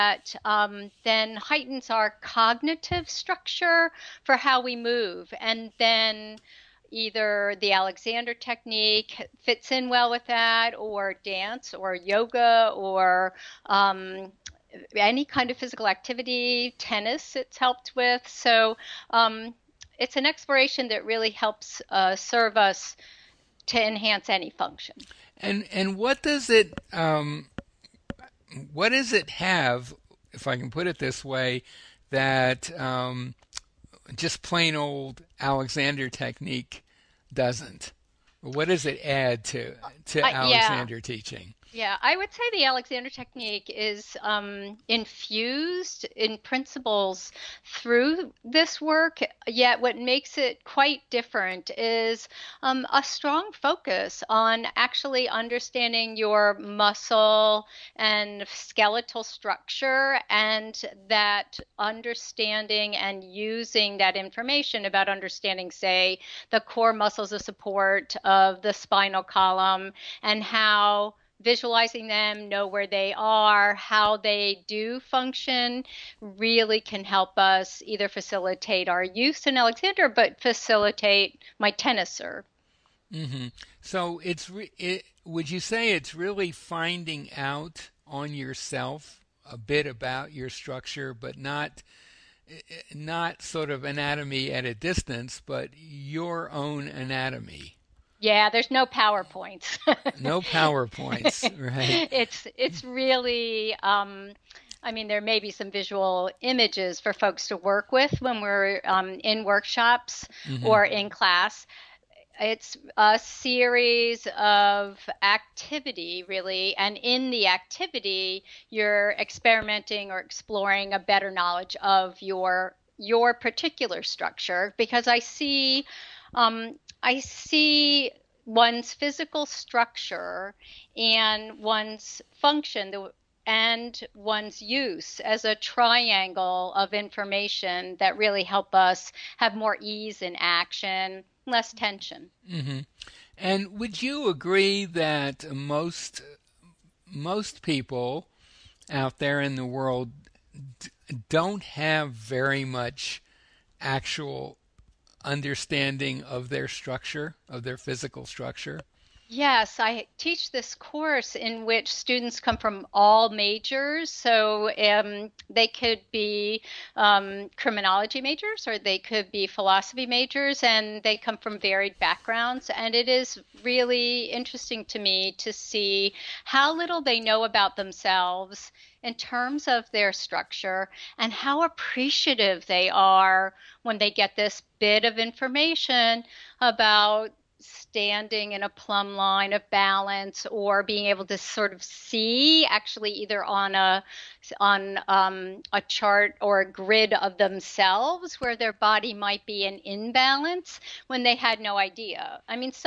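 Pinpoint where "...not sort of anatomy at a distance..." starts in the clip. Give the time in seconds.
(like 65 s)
92 s.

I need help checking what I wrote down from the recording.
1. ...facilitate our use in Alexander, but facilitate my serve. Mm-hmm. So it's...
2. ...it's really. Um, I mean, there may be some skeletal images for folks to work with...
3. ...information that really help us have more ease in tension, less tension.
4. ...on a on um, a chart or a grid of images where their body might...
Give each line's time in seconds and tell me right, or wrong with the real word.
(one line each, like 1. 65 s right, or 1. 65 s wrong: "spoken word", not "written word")
1. 78 s right
2. 102 s wrong: "visual", not "skeletal"
3. 136 s wrong: "action", not "tension"
4. 193 s wrong: "themselves", not "images".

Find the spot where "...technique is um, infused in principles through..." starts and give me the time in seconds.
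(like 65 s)
43 s.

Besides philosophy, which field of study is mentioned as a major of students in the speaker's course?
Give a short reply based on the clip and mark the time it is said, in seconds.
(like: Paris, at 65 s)
Criminology, at 167 s.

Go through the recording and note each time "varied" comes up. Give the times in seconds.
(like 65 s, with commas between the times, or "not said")
171 s.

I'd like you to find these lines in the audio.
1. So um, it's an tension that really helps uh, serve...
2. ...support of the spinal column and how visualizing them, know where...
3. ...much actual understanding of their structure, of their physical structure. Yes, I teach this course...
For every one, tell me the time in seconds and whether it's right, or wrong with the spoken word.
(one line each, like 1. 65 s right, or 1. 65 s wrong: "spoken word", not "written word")
1. 18 s wrong: "exploration", not "tension"
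2. 67 s right
3. 152 s right.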